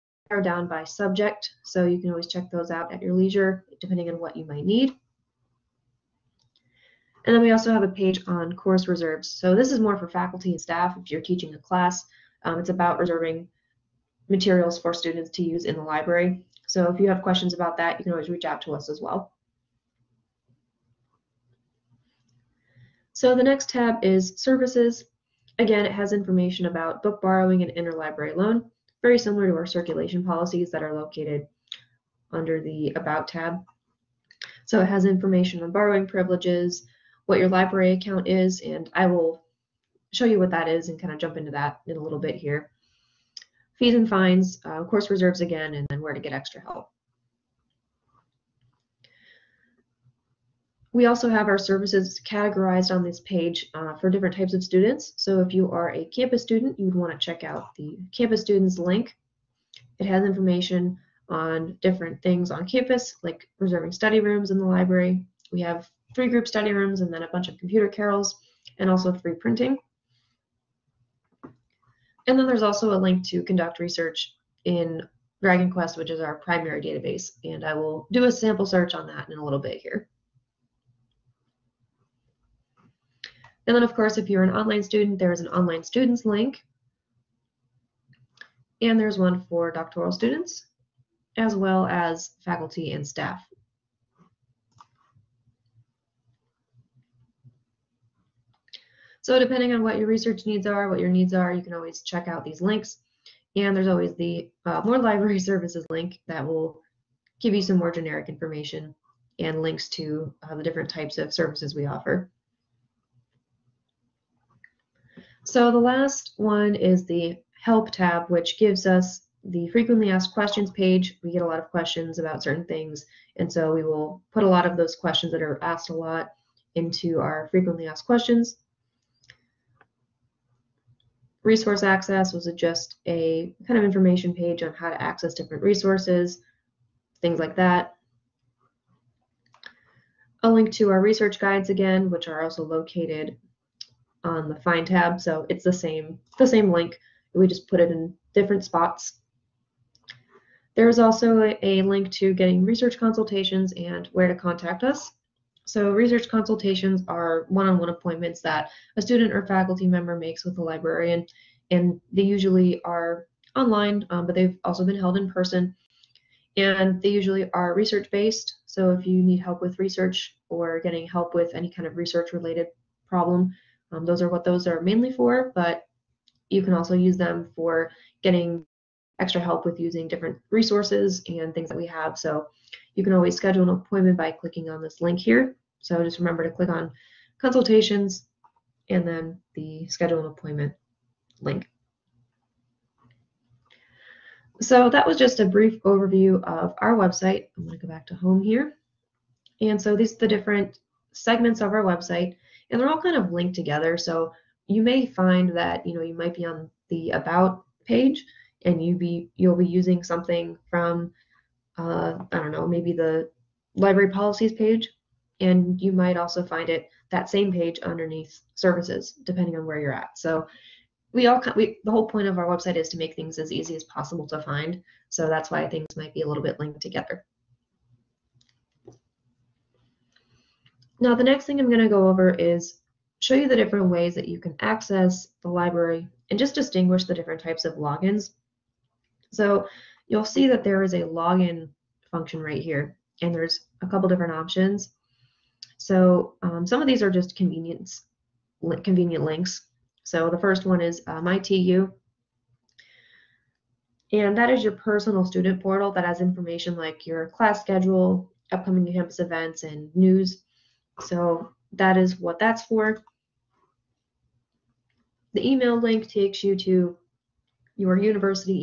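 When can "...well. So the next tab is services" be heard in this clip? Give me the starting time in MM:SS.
00:19.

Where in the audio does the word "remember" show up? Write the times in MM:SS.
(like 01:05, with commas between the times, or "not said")
03:06.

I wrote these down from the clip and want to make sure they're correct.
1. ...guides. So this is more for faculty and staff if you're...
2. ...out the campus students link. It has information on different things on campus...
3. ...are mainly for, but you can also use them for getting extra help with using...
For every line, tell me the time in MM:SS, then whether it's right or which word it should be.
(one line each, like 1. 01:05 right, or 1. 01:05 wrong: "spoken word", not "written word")
1. 00:08 wrong: "reserves", not "guides"
2. 00:57 right
3. 02:54 right.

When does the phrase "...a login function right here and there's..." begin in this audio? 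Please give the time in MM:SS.
04:00.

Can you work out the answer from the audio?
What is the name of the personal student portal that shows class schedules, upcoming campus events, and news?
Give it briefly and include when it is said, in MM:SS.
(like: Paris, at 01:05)
MyTU, at 04:11.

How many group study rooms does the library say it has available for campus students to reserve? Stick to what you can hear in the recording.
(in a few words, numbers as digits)
3.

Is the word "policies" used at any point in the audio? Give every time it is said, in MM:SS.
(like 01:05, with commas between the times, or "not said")
00:30, 03:34.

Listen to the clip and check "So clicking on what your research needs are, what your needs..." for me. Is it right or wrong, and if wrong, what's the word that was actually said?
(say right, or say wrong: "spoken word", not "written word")
wrong: "depending", not "clicking".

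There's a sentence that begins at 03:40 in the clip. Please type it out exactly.
So we all we, the whole point of our website is to make things as easy as possible to find.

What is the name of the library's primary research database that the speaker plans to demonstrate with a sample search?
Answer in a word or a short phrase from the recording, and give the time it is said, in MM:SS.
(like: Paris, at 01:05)
Dragon Quest, at 01:15.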